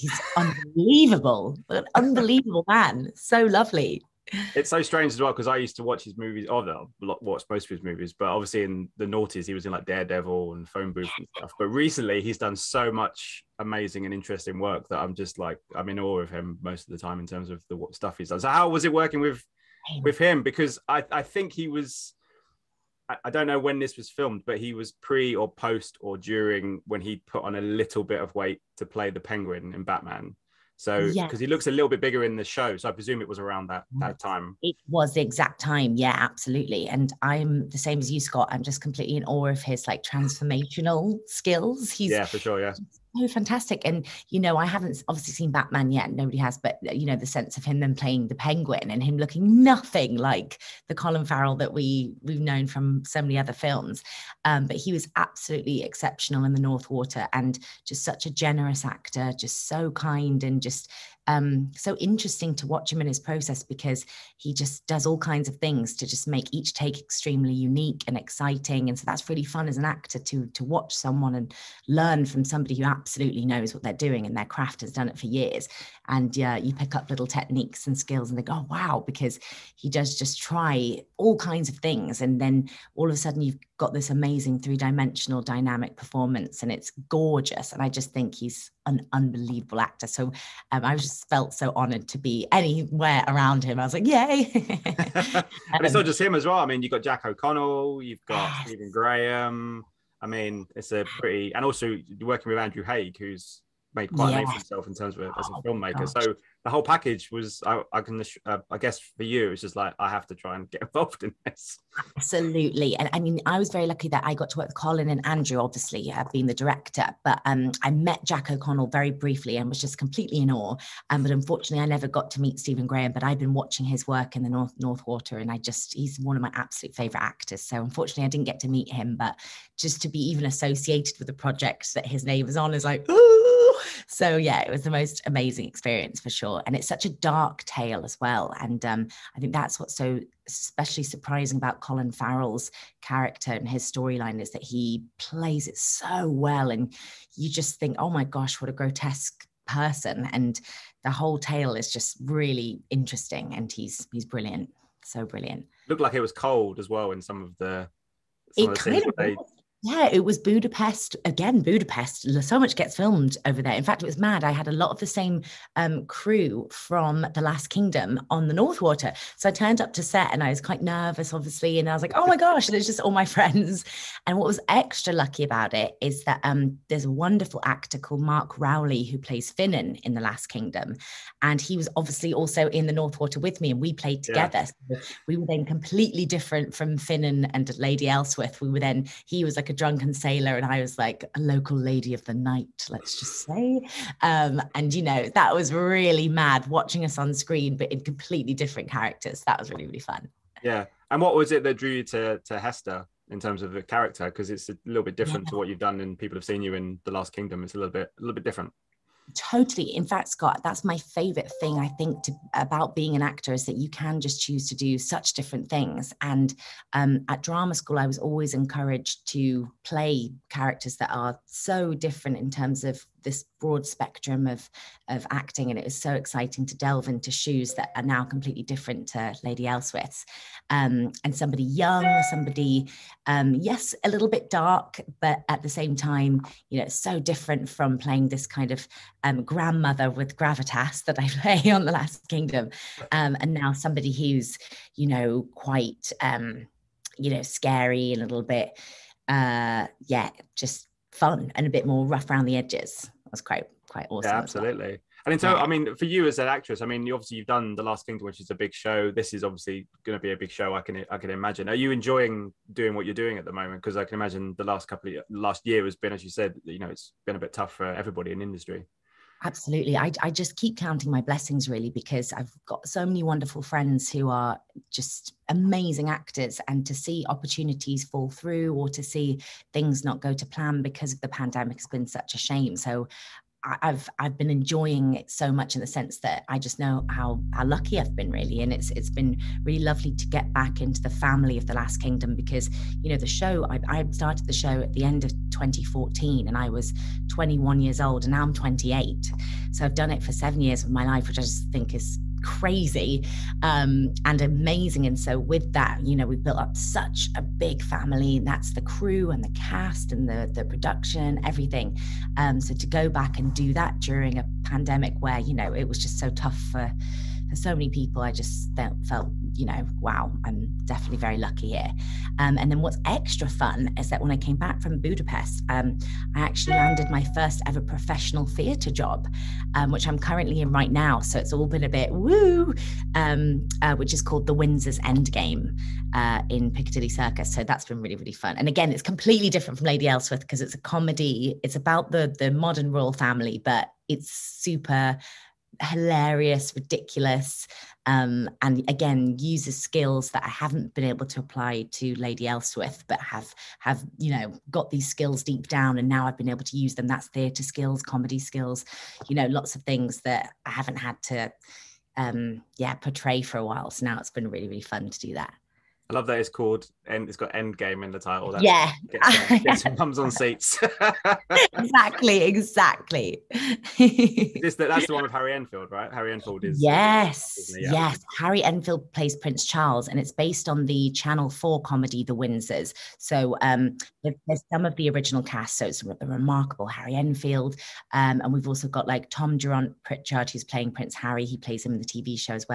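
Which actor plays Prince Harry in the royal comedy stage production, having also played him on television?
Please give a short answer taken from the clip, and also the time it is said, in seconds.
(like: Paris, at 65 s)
Tom Durant Pritchard, at 389 s.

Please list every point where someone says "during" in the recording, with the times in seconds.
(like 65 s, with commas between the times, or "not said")
26 s, 313 s.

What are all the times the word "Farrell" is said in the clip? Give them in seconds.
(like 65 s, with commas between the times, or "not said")
51 s, 142 s.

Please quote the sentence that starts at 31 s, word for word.
he looks a little bit bigger in the show, so I presume it was around that mm.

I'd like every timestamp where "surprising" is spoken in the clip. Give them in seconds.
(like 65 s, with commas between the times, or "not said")
141 s.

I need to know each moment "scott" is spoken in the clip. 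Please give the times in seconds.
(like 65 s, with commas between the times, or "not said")
38 s, 210 s.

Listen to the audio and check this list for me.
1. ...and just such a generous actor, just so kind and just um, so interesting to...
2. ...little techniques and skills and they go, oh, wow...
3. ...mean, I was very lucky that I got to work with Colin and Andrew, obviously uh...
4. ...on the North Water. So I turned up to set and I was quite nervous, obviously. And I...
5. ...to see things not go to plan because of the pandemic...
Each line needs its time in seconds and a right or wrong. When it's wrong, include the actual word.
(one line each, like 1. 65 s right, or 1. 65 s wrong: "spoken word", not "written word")
1. 57 s right
2. 77 s right
3. 113 s right
4. 168 s right
5. 278 s right.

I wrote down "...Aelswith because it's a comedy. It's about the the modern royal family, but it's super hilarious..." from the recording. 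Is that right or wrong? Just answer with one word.
right.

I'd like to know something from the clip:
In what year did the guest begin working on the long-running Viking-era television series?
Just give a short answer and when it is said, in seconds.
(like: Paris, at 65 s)
2014, at 295 s.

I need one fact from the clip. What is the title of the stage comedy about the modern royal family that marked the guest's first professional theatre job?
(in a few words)
The Windsor's Endgame.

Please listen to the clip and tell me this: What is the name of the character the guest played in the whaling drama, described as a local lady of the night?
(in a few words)
Hester.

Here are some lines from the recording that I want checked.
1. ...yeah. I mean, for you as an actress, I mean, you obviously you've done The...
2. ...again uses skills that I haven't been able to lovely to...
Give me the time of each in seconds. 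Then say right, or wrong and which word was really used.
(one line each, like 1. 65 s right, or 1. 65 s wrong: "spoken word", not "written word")
1. 255 s right
2. 348 s wrong: "apply", not "lovely".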